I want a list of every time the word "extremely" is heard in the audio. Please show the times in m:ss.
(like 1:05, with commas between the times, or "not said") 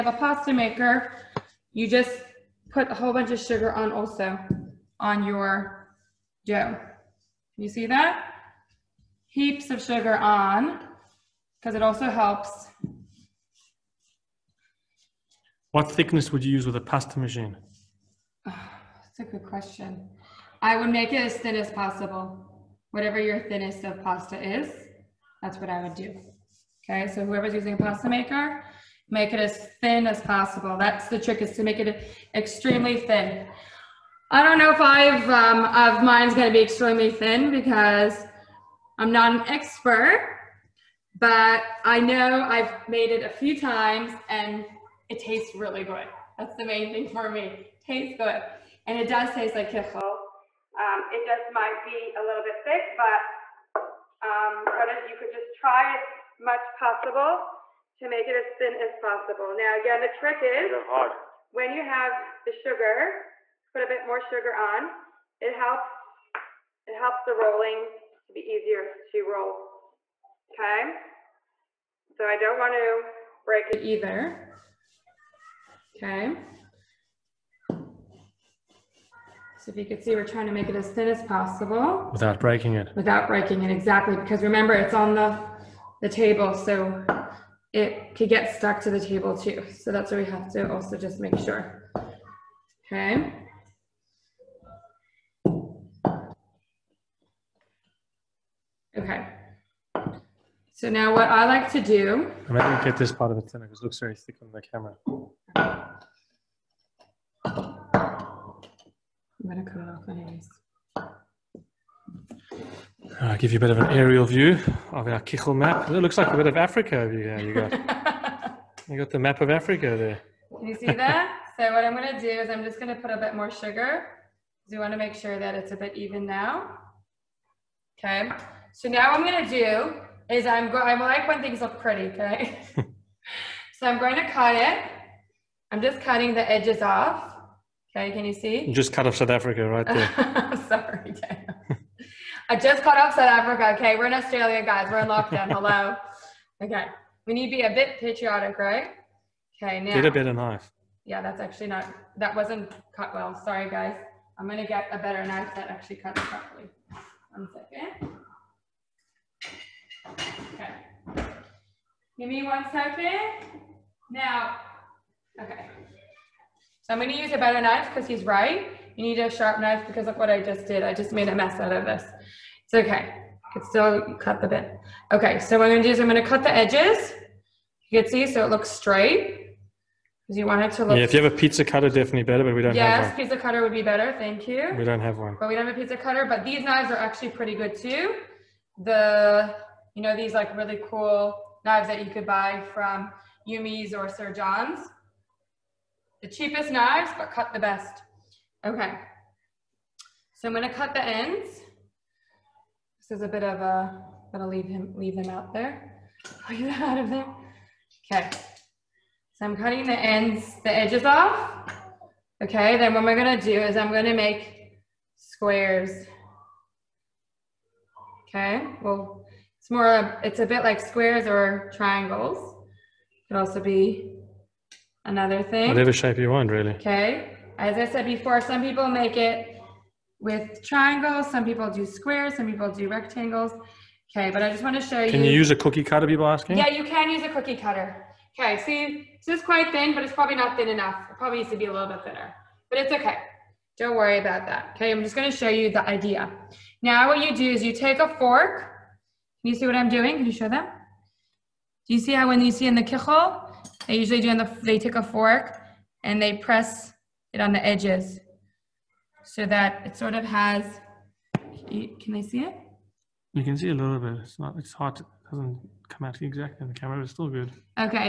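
0:32, 0:36.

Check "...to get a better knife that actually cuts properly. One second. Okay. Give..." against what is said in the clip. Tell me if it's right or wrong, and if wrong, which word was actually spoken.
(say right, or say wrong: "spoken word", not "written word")
right.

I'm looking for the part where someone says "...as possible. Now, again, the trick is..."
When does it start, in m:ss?
0:58.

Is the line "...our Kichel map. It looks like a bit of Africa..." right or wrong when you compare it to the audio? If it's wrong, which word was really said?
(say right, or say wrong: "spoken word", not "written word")
right.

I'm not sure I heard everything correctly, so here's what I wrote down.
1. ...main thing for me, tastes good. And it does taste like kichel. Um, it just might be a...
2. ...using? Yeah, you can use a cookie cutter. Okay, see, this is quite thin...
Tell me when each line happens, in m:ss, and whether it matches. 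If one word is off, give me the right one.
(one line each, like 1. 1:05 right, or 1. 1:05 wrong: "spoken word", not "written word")
1. 0:46 right
2. 3:56 wrong: "asking", not "using".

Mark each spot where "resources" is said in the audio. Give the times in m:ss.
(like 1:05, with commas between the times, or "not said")
not said.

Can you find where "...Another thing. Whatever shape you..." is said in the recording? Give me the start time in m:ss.
3:45.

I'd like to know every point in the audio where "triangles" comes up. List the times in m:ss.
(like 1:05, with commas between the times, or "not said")
3:41, 3:50.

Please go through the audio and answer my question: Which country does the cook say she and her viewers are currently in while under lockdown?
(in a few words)
Australia.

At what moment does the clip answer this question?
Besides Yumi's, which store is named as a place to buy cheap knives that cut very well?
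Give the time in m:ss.
3:14.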